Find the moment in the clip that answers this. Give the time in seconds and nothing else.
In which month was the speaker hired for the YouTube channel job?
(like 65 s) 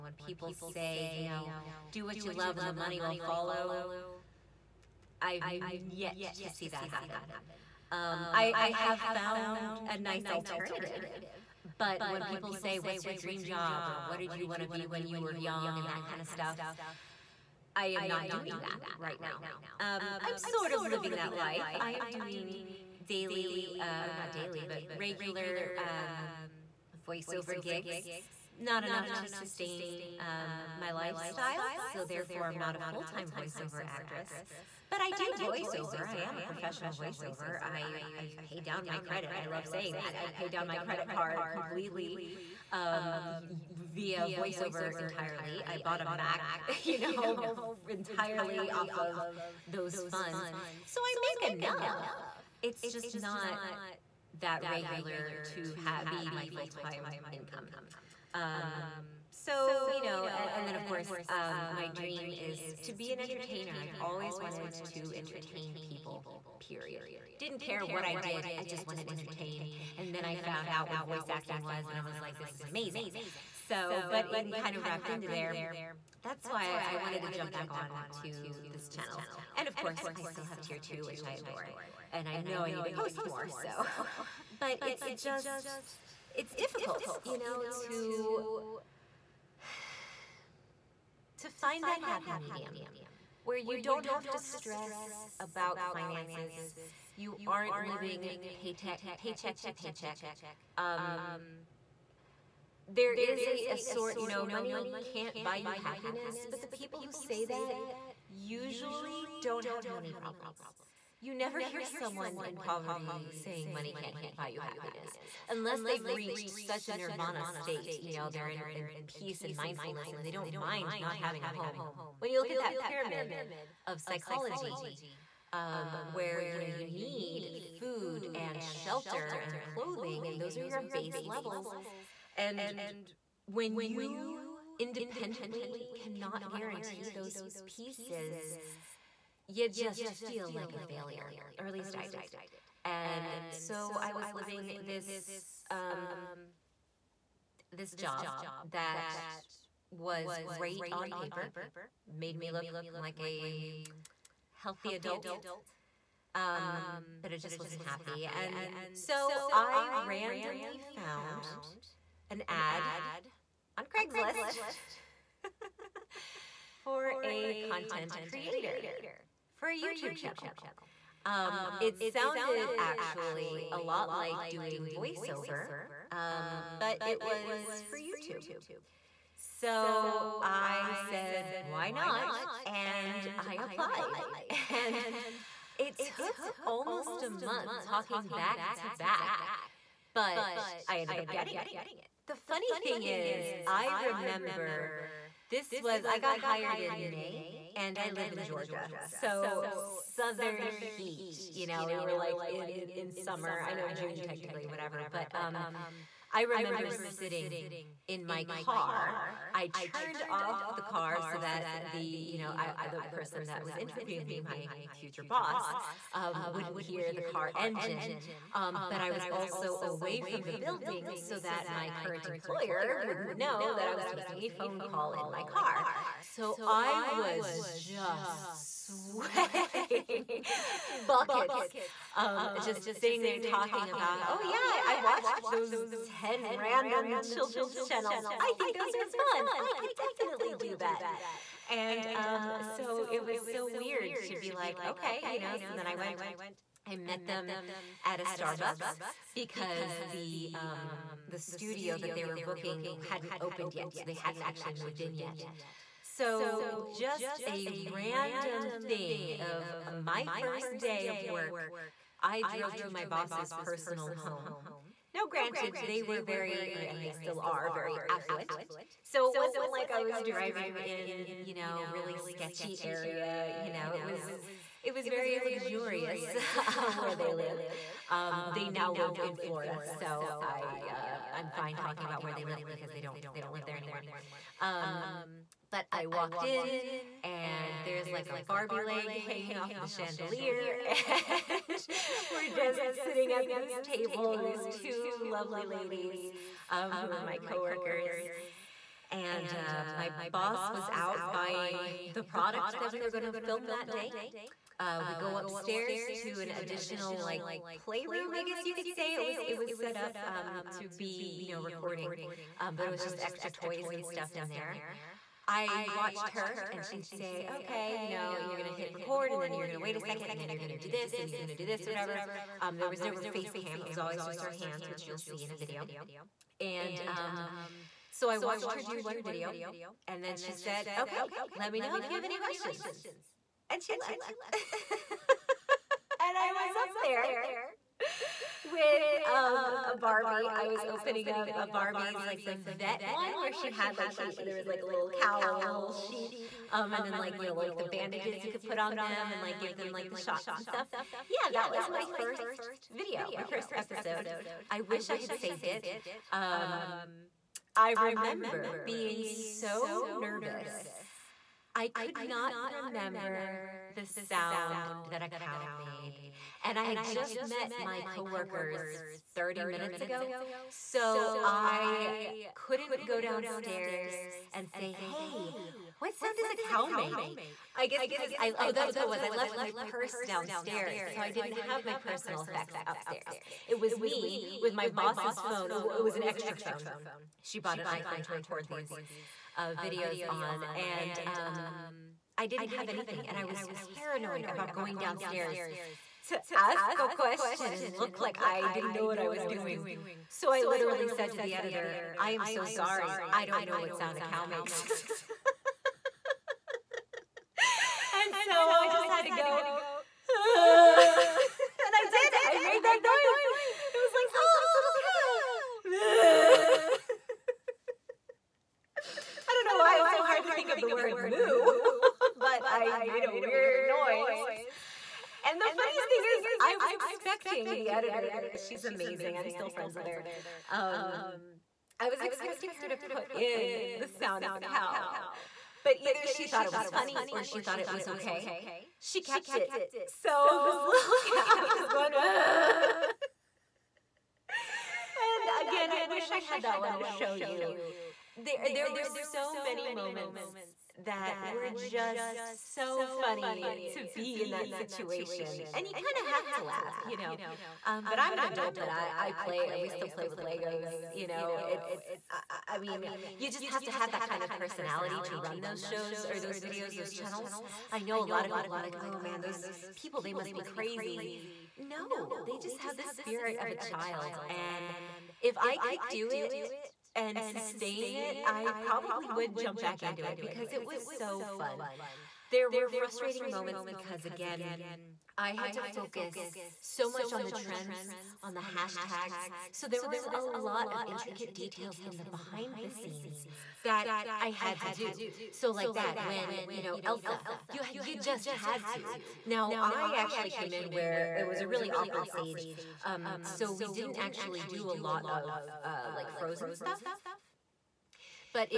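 197 s.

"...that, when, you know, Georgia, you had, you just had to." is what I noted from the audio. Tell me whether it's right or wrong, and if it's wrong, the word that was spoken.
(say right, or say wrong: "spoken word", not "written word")
wrong: "Elsa", not "Georgia".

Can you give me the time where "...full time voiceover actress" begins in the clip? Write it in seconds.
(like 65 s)
32 s.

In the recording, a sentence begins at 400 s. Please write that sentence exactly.
So I literally said to the editor, I am so sorry.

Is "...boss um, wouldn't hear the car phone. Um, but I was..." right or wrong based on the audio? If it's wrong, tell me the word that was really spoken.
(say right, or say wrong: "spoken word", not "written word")
wrong: "engine", not "phone".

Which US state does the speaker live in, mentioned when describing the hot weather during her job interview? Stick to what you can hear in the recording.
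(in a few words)
Georgia.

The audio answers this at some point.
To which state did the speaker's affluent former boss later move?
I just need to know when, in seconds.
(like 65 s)
279 s.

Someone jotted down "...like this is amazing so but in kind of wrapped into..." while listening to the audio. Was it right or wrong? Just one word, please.
right.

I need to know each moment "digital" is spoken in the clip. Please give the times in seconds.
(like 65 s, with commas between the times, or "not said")
not said.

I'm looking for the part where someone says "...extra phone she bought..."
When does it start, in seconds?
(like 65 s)
386 s.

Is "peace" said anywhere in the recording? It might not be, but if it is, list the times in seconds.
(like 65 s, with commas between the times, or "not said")
119 s.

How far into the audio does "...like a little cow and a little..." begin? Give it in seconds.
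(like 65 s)
344 s.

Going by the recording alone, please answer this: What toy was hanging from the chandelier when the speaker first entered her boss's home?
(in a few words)
Barbie leg.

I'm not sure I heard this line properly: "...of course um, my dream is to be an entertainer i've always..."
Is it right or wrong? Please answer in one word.
right.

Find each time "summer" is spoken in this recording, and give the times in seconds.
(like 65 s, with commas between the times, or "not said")
203 s.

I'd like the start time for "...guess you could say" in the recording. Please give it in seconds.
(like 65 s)
308 s.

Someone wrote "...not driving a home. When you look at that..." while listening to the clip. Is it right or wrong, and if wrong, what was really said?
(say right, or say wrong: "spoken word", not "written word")
wrong: "having", not "driving".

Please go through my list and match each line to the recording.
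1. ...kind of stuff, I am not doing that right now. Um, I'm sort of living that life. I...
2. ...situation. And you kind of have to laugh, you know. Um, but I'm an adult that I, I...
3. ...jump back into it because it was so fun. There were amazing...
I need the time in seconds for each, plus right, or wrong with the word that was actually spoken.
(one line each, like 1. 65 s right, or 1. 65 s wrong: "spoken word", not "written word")
1. 16 s right
2. 454 s right
3. 479 s wrong: "frustrating", not "amazing".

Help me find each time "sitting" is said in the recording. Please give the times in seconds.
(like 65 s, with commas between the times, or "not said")
206 s, 232 s, 293 s.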